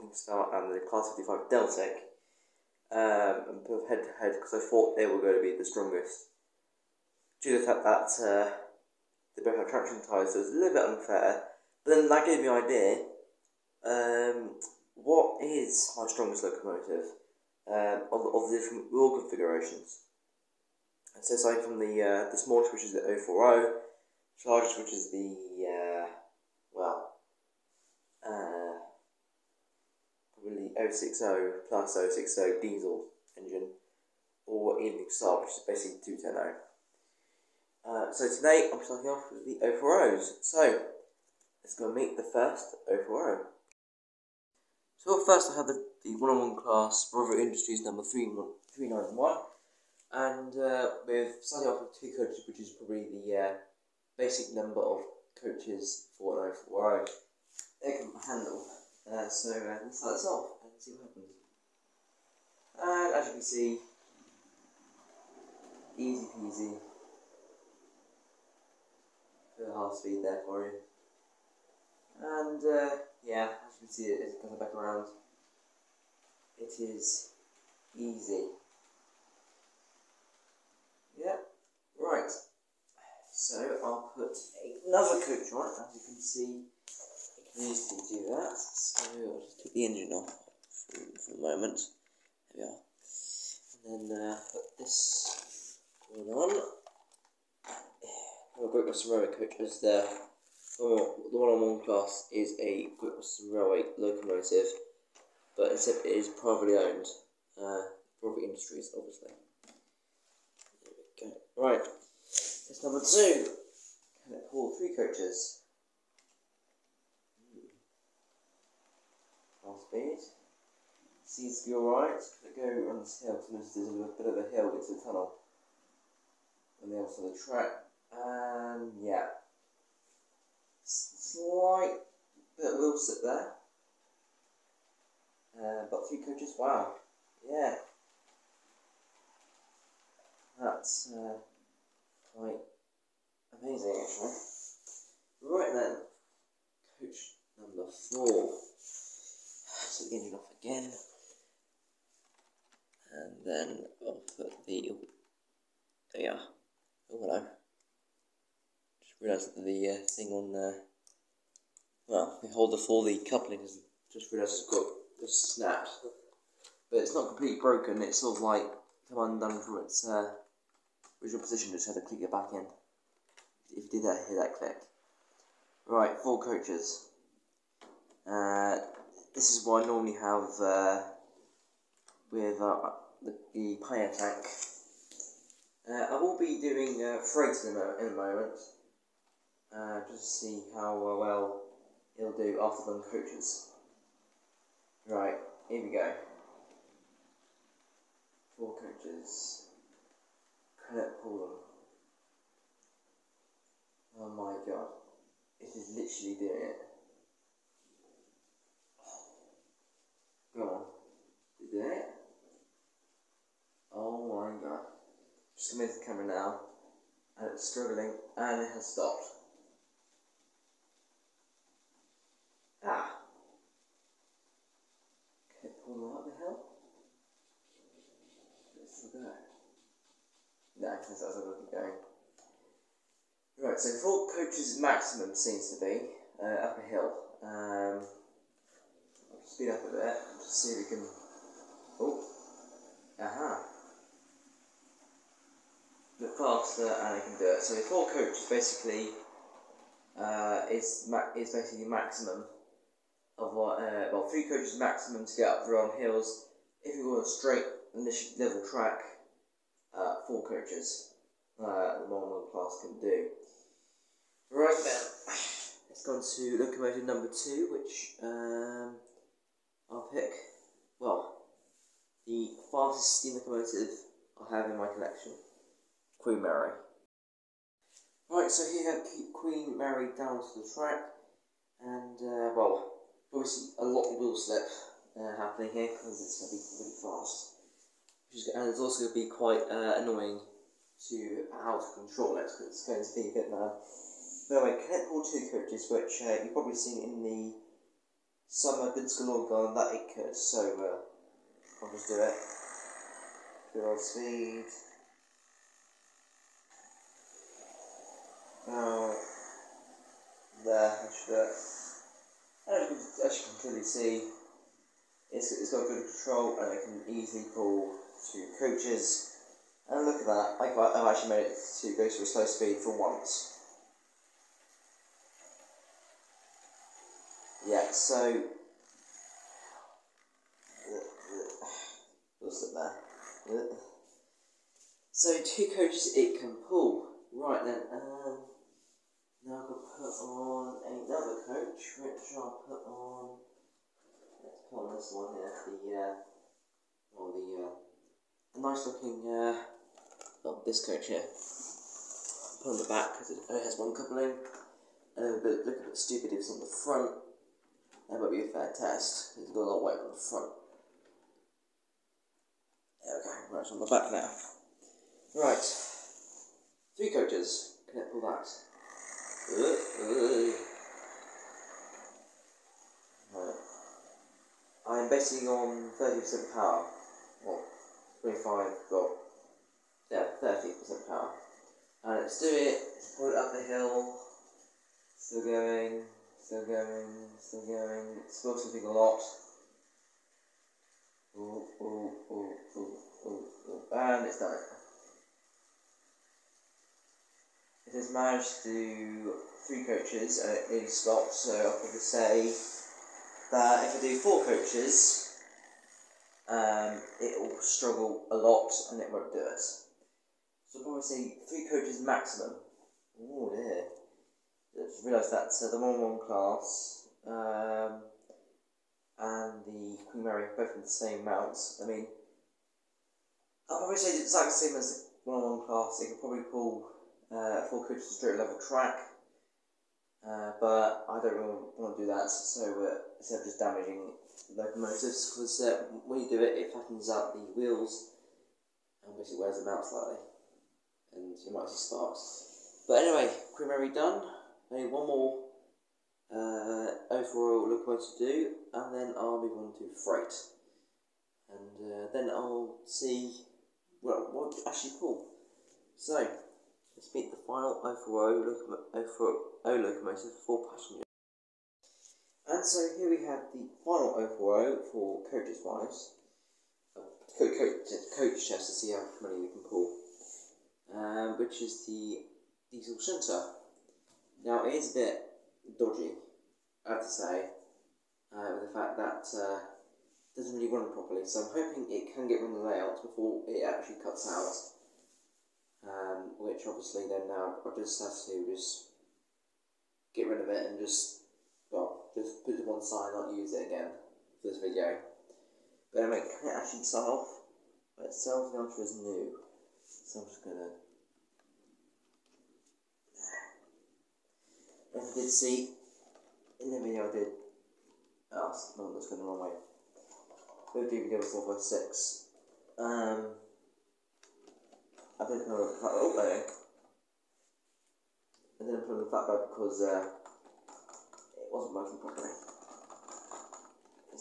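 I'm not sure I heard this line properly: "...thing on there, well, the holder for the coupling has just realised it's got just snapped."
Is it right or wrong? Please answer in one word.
right.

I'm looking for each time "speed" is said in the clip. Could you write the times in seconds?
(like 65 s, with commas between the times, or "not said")
69 s, 119 s, 239 s, 304 s, 322 s.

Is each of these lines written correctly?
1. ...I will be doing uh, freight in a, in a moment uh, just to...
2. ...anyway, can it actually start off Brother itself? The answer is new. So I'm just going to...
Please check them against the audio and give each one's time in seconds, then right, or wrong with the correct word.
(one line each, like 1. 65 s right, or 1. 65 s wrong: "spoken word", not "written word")
1. 186 s right
2. 496 s wrong: "But", not "Brother".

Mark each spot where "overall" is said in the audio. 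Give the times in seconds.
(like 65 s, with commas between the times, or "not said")
447 s, 457 s, 464 s.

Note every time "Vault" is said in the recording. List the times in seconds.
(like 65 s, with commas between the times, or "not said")
234 s, 247 s.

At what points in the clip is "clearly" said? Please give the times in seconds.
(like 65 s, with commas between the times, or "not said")
313 s.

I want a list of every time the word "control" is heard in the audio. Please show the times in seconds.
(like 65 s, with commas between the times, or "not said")
292 s, 316 s.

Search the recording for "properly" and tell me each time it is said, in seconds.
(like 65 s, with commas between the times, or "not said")
480 s, 522 s.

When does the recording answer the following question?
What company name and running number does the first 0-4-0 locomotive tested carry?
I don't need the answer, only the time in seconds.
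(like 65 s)
47 s.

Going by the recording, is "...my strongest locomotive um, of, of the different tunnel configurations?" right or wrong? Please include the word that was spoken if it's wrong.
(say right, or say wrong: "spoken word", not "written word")
wrong: "wheel", not "tunnel".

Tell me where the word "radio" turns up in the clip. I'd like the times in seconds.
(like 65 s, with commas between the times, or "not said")
not said.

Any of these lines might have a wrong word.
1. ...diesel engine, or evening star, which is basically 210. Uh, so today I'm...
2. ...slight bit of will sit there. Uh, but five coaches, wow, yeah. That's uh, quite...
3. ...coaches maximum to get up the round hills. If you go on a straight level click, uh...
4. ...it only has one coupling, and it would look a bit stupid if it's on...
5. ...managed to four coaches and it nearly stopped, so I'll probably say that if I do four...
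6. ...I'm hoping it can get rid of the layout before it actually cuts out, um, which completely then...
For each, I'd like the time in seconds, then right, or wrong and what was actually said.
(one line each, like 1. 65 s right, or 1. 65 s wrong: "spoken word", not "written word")
1. 32 s right
2. 130 s wrong: "three", not "five"
3. 254 s wrong: "track", not "click"
4. 353 s right
5. 398 s wrong: "three", not "four"
6. 481 s wrong: "obviously", not "completely".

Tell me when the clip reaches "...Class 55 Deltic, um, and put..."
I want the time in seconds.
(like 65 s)
0 s.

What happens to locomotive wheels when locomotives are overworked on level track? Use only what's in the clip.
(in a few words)
flattens out the wheels.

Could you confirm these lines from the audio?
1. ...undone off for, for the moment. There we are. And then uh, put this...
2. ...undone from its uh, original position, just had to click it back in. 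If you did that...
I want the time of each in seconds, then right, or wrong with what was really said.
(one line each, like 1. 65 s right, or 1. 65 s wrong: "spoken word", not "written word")
1. 89 s wrong: "engine", not "undone"
2. 169 s right.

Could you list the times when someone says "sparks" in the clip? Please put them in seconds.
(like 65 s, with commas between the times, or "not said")
441 s.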